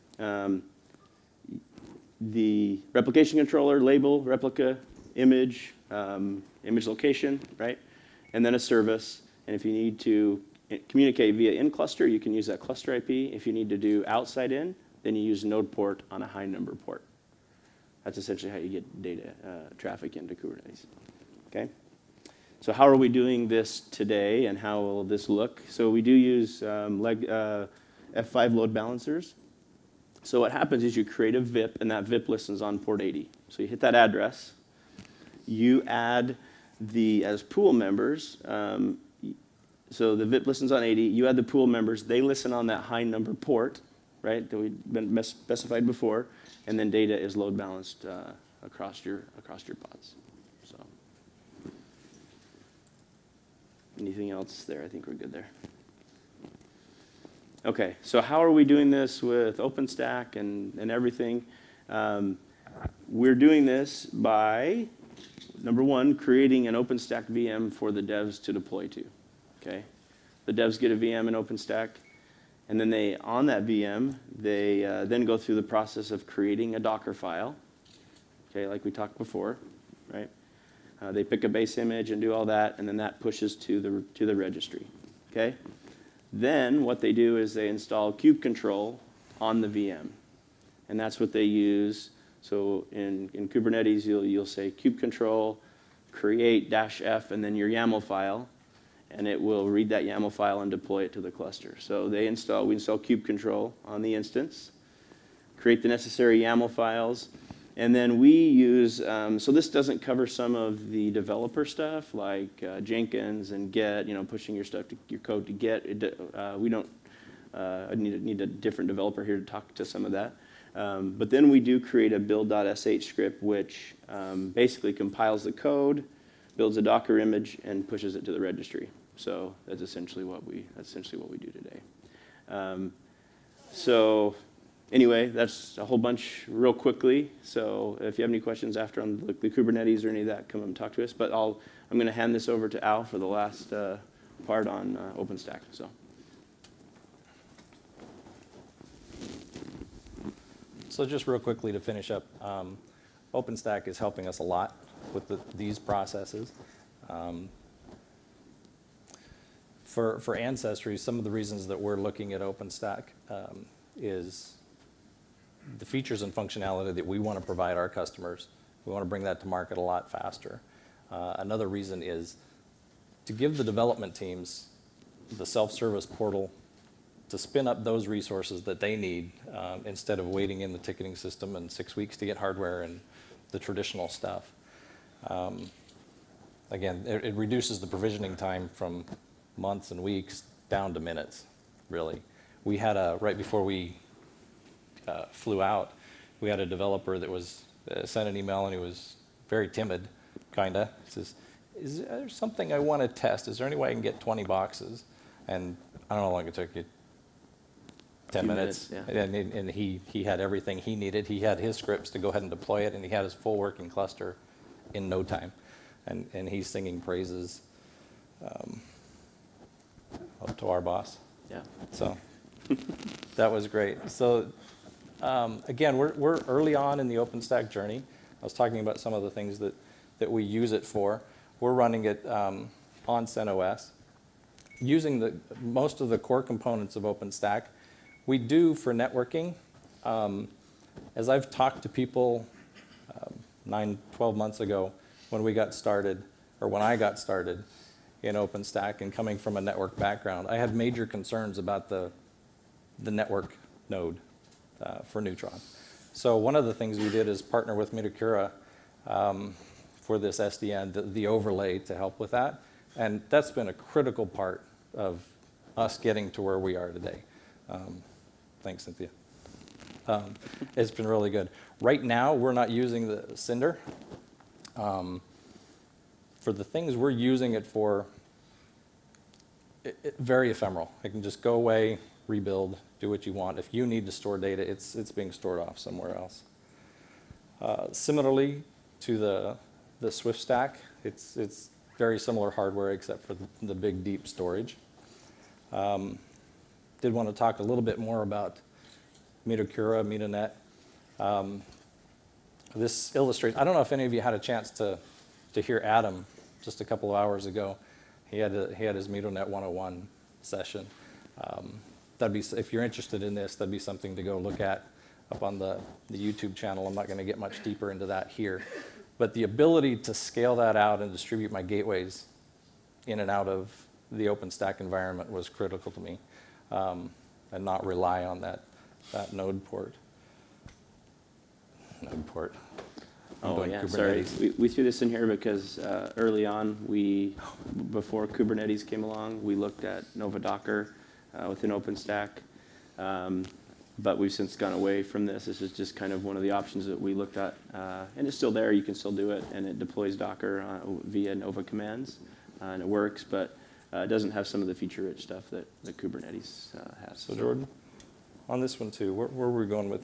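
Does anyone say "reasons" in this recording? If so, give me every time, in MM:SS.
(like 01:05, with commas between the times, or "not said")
02:41, 02:51.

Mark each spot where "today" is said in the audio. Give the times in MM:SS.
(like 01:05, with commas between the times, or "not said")
00:23, 02:11, 04:26.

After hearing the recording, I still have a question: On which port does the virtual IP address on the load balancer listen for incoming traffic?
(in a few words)
80.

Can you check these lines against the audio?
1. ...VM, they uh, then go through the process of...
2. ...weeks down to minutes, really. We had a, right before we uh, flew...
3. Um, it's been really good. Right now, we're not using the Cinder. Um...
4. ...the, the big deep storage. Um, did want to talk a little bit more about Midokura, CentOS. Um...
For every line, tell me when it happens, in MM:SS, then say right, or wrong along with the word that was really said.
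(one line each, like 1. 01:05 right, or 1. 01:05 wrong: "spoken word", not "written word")
1. 01:13 right
2. 03:10 right
3. 04:30 right
4. 04:53 wrong: "MidoNet", not "CentOS".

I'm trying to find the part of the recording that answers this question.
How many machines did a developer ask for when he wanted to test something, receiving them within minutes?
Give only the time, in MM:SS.
03:24.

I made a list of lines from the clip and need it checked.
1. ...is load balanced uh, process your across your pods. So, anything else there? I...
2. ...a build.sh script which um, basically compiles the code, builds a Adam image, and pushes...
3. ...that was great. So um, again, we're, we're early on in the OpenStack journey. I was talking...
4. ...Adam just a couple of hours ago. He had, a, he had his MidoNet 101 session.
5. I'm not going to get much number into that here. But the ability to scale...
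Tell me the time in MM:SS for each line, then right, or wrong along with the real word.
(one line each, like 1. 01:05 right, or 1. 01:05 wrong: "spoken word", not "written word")
1. 00:47 wrong: "across", not "process"
2. 02:02 wrong: "Docker", not "Adam"
3. 03:43 right
4. 05:05 right
5. 05:16 wrong: "deeper", not "number".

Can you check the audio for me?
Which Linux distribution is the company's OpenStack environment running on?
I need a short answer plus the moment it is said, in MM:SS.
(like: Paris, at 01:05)
CentOS, at 03:53.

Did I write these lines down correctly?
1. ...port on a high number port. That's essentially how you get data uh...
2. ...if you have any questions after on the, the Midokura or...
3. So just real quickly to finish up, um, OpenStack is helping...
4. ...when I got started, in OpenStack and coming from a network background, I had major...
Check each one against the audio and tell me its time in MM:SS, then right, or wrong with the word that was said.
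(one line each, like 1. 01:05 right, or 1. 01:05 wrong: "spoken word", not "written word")
1. 00:15 right
2. 02:17 wrong: "Kubernetes", not "Midokura"
3. 02:30 right
4. 04:06 right.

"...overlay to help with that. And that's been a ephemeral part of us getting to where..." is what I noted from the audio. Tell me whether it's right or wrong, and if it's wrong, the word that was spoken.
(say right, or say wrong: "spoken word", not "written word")
wrong: "critical", not "ephemeral".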